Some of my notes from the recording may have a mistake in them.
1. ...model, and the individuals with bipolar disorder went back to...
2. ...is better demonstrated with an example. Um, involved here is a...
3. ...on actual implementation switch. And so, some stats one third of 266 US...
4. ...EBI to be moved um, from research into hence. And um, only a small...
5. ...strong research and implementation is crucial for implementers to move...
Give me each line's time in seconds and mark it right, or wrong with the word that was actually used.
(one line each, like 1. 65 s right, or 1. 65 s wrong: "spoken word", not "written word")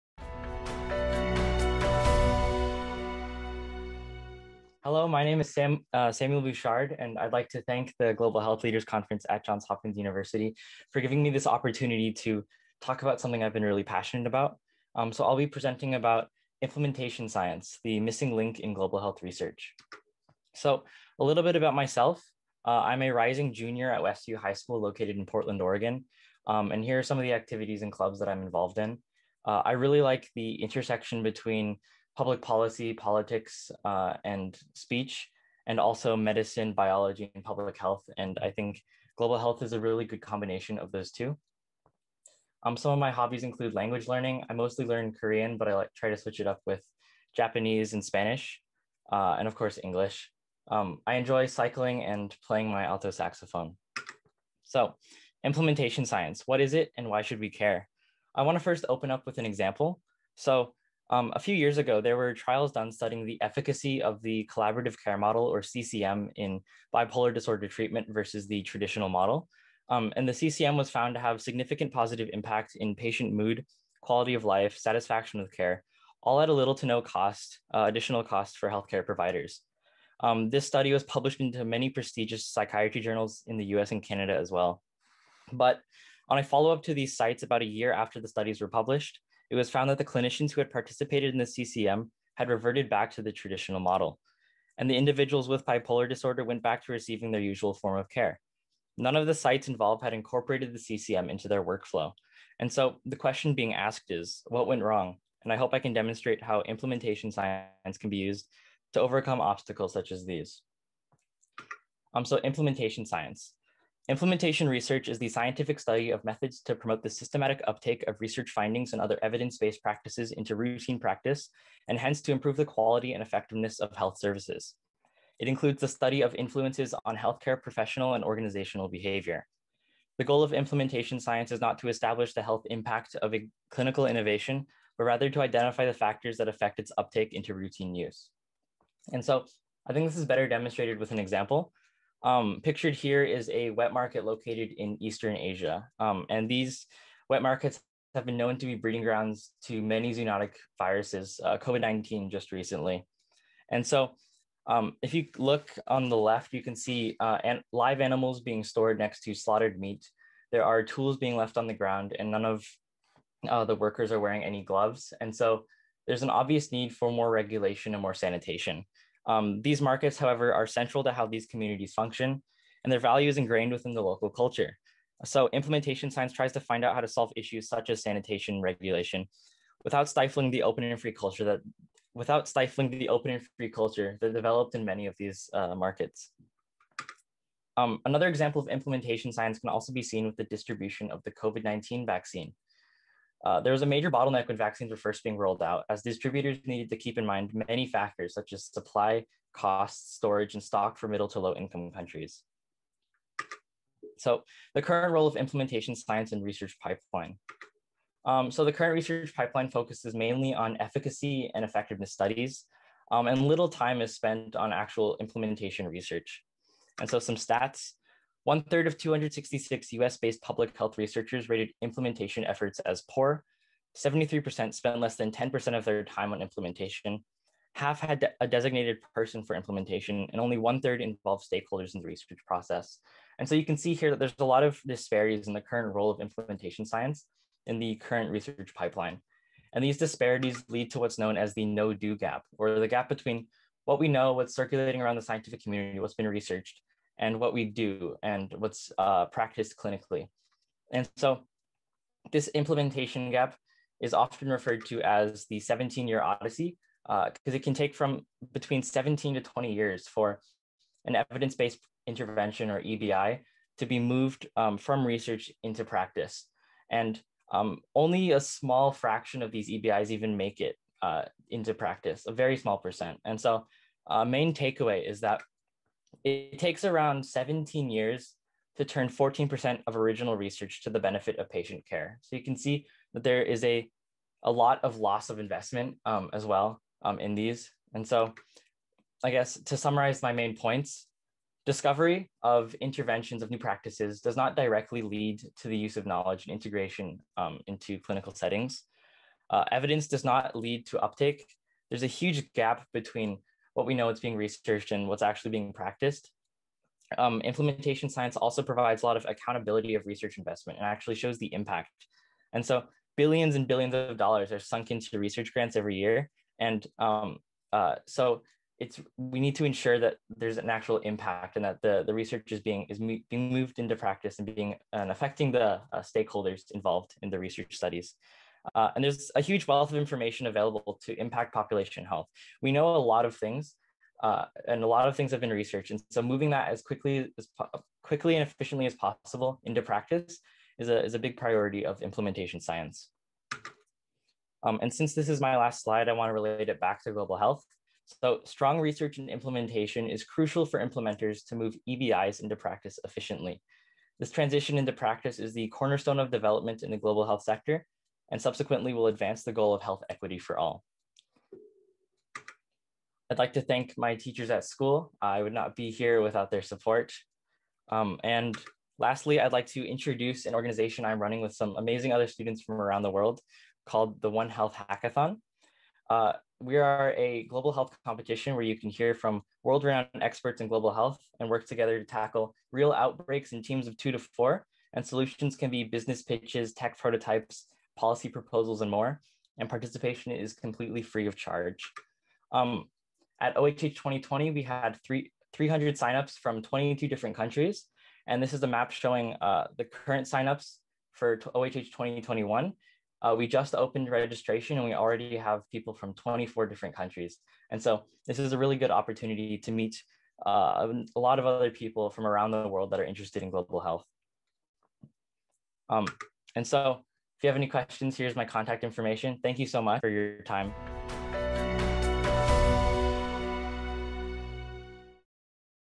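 1. 93 s right
2. 140 s wrong: "pictured", not "involved"
3. 214 s wrong: "research", not "switch"
4. 262 s wrong: "practice", not "hence"
5. 348 s right.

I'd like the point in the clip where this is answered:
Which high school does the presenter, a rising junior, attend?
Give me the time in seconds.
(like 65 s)
24 s.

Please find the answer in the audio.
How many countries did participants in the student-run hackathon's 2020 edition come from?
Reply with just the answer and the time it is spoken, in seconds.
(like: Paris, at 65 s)
22, at 396 s.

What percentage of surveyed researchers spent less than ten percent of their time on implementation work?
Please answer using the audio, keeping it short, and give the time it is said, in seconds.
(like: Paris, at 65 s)
73%, at 223 s.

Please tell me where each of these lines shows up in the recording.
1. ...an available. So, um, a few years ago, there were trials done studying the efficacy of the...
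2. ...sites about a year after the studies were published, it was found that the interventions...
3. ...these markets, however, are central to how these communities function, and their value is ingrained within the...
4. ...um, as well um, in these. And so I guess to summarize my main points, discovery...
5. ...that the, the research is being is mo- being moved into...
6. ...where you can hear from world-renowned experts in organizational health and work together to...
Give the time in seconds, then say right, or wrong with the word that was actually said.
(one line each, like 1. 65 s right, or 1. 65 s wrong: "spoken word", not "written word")
1. 59 s wrong: "example", not "available"
2. 87 s wrong: "clinicians", not "interventions"
3. 169 s right
4. 286 s right
5. 321 s right
6. 378 s wrong: "global", not "organizational".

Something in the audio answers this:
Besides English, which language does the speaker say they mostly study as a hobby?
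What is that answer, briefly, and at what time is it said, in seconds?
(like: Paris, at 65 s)
Korean, at 45 s.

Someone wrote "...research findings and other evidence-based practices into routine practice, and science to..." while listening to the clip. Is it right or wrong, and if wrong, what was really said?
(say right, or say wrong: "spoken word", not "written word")
wrong: "hence", not "science".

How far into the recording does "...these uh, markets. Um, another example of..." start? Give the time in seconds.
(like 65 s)
185 s.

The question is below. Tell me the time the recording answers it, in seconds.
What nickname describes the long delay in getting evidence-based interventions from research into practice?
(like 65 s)
255 s.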